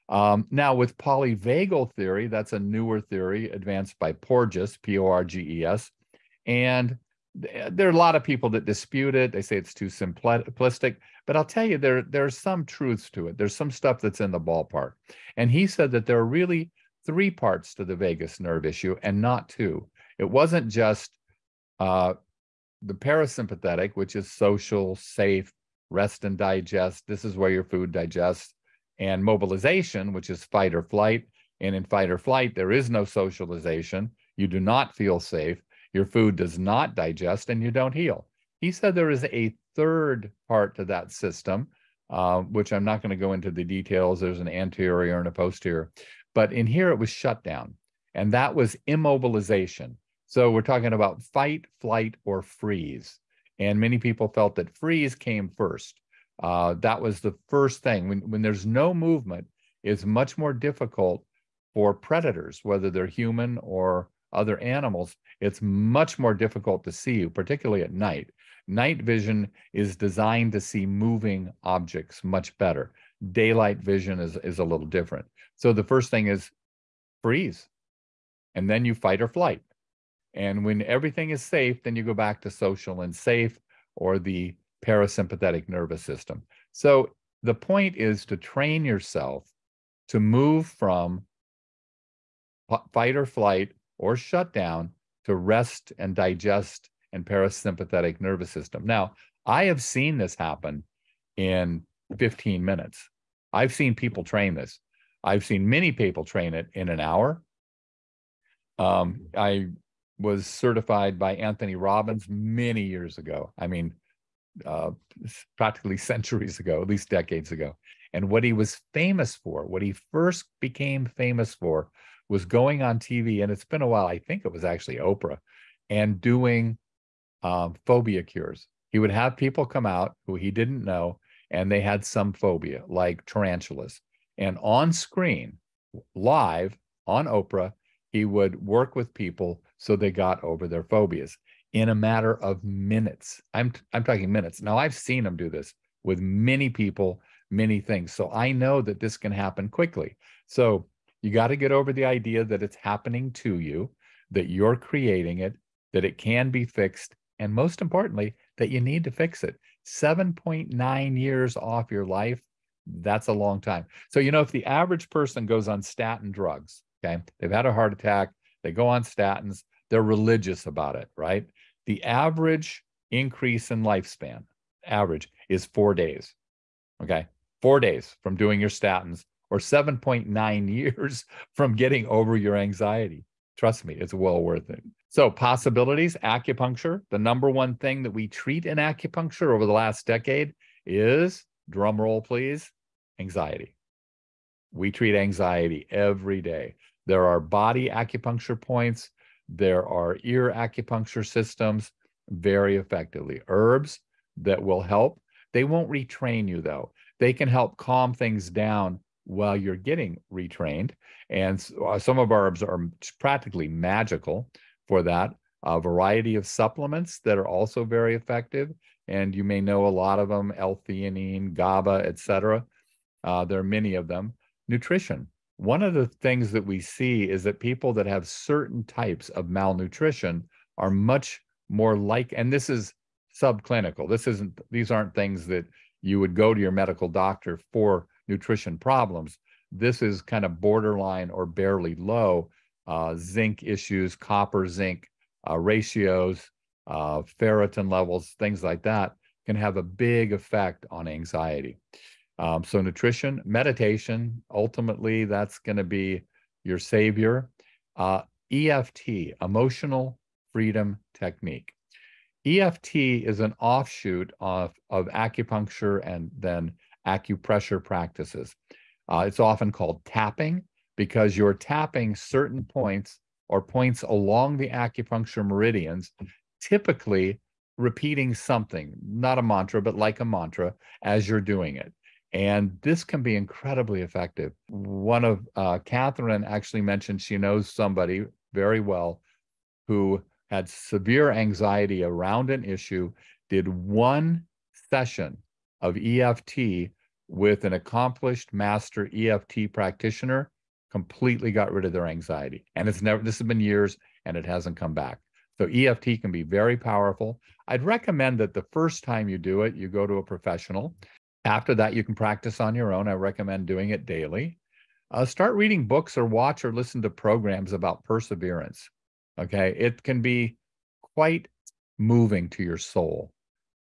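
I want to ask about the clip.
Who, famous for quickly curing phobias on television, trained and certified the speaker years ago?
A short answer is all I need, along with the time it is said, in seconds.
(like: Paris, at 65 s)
Anthony Robbins, at 111 s.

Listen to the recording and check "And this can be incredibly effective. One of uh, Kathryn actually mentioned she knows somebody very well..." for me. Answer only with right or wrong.
right.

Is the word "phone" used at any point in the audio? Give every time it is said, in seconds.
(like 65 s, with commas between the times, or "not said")
not said.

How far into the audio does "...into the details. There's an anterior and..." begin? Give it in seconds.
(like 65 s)
43 s.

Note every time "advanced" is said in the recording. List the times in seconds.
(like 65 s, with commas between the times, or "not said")
3 s.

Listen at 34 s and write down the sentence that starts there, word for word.
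You do not feel safe your food does not digest and you don't heal.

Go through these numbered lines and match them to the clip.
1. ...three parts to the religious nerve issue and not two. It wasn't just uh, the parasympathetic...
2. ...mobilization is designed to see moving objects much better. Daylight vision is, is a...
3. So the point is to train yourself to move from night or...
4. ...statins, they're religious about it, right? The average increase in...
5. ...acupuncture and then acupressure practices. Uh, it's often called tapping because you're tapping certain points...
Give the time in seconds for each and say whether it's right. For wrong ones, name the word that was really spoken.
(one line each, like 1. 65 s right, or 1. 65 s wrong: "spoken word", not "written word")
1. 17 s wrong: "vagus", not "religious"
2. 69 s wrong: "vision", not "mobilization"
3. 86 s wrong: "fight", not "night"
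4. 169 s right
5. 265 s right.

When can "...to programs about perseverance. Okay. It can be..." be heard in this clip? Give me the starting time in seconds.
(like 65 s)
317 s.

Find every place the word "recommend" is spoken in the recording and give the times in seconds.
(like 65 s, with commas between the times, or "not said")
307 s, 313 s.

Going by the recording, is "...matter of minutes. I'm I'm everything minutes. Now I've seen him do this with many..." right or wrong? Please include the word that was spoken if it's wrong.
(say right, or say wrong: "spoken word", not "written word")
wrong: "talking", not "everything".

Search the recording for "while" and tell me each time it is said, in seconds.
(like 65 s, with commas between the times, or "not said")
123 s, 209 s.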